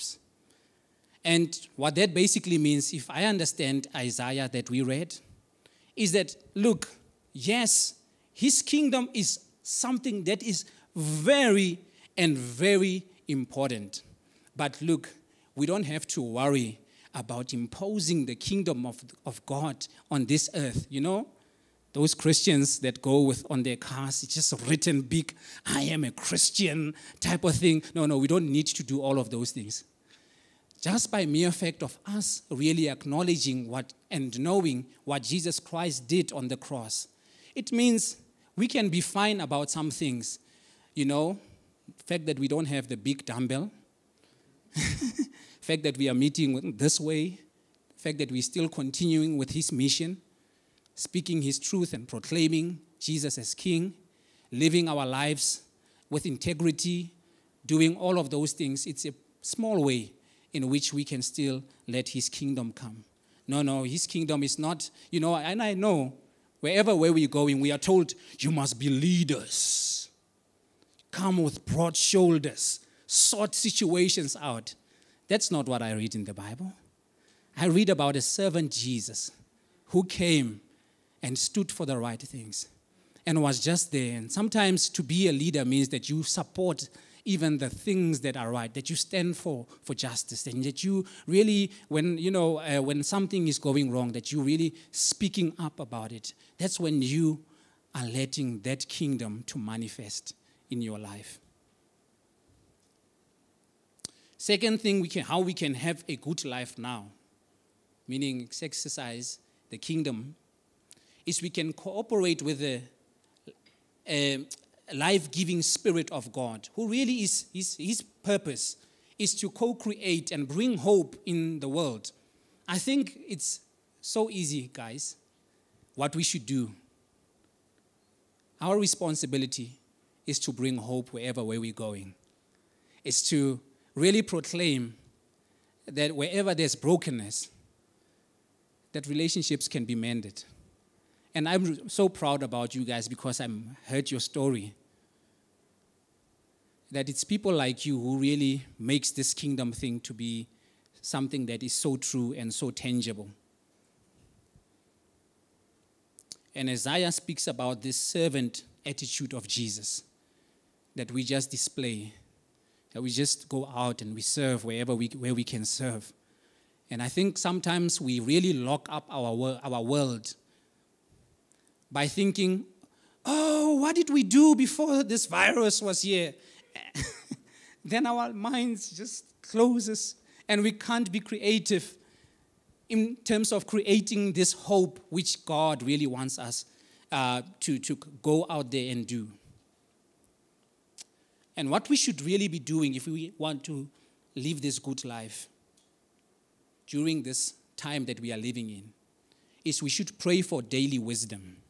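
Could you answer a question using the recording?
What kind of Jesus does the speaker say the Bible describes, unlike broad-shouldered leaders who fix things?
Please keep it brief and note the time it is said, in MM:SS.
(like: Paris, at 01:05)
A servant Jesus, at 01:18.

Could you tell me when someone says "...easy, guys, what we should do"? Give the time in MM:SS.
02:04.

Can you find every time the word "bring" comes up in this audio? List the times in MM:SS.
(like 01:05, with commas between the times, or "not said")
02:00, 02:10.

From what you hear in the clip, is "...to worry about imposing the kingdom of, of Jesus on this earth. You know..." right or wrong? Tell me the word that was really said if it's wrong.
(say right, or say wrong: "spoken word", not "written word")
wrong: "God", not "Jesus".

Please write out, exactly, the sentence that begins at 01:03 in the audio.
No, no, his kingdom is not, you know, and I know wherever where we're going, we are told you must be leaders.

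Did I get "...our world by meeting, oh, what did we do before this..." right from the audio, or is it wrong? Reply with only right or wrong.
wrong.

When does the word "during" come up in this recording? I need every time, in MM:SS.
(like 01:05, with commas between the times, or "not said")
03:16.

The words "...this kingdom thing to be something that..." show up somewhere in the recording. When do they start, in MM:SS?
02:29.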